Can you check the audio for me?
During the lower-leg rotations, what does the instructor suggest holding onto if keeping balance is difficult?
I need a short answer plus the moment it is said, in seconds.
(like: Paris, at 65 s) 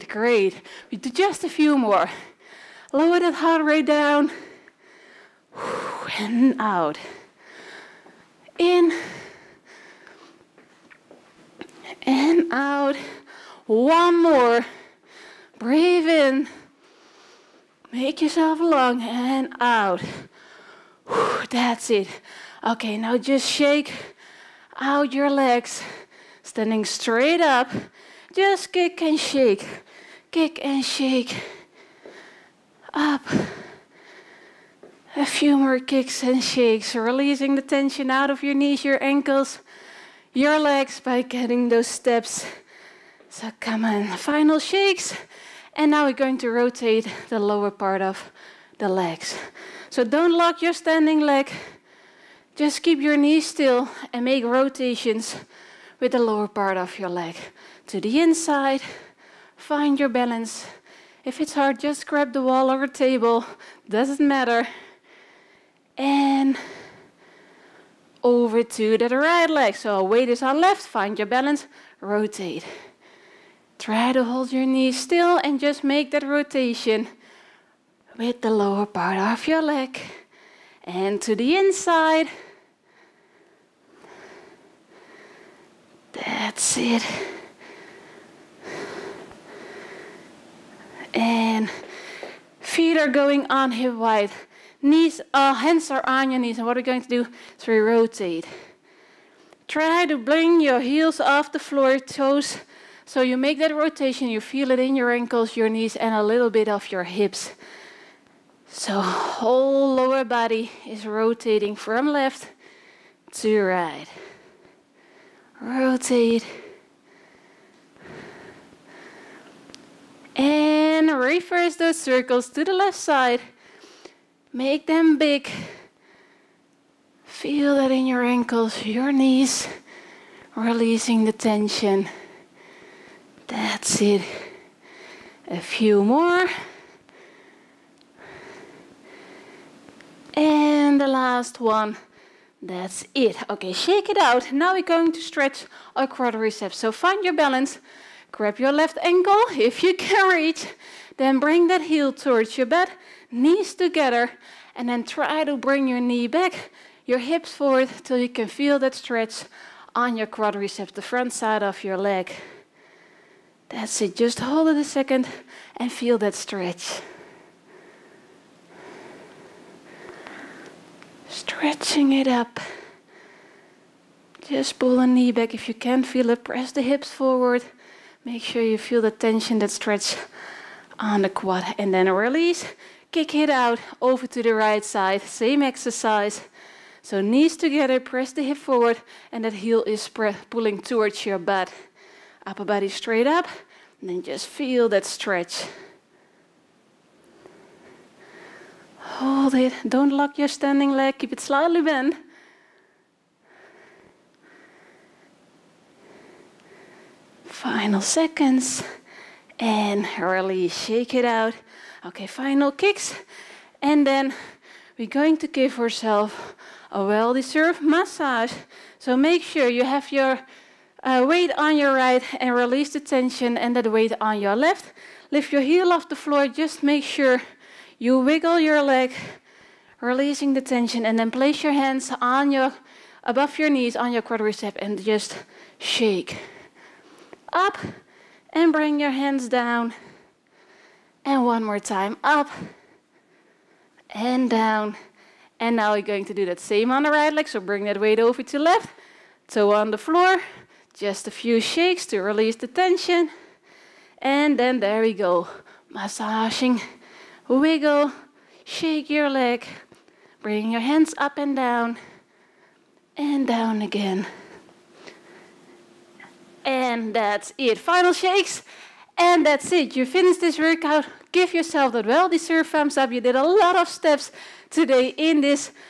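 the wall or a table, at 62 s.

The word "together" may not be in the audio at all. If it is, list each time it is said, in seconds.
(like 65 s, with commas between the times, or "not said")
153 s, 187 s.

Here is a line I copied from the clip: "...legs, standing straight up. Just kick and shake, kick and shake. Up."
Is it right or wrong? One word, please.
right.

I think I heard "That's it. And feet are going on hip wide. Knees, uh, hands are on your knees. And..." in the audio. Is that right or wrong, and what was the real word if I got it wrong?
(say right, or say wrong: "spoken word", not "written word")
right.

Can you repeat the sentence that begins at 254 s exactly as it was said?
And then there we go, massaging wiggle, shake your leg, bring your hands up and down, and down again.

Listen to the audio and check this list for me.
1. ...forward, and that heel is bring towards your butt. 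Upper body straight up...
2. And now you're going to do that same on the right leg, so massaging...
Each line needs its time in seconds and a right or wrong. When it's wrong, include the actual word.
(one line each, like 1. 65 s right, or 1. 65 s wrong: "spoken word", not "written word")
1. 188 s wrong: "pulling", not "bring"
2. 245 s wrong: "bring", not "massaging".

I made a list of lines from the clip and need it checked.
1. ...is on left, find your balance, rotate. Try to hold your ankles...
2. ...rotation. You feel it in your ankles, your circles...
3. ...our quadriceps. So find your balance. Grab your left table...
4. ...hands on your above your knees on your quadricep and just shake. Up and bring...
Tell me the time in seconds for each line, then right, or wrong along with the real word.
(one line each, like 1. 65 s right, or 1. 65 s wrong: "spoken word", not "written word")
1. 70 s wrong: "knees", not "ankles"
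2. 103 s wrong: "knees", not "circles"
3. 145 s wrong: "ankle", not "table"
4. 231 s right.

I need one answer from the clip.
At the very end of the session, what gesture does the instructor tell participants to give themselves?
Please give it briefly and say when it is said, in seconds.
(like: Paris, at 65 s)
thumbs up, at 272 s.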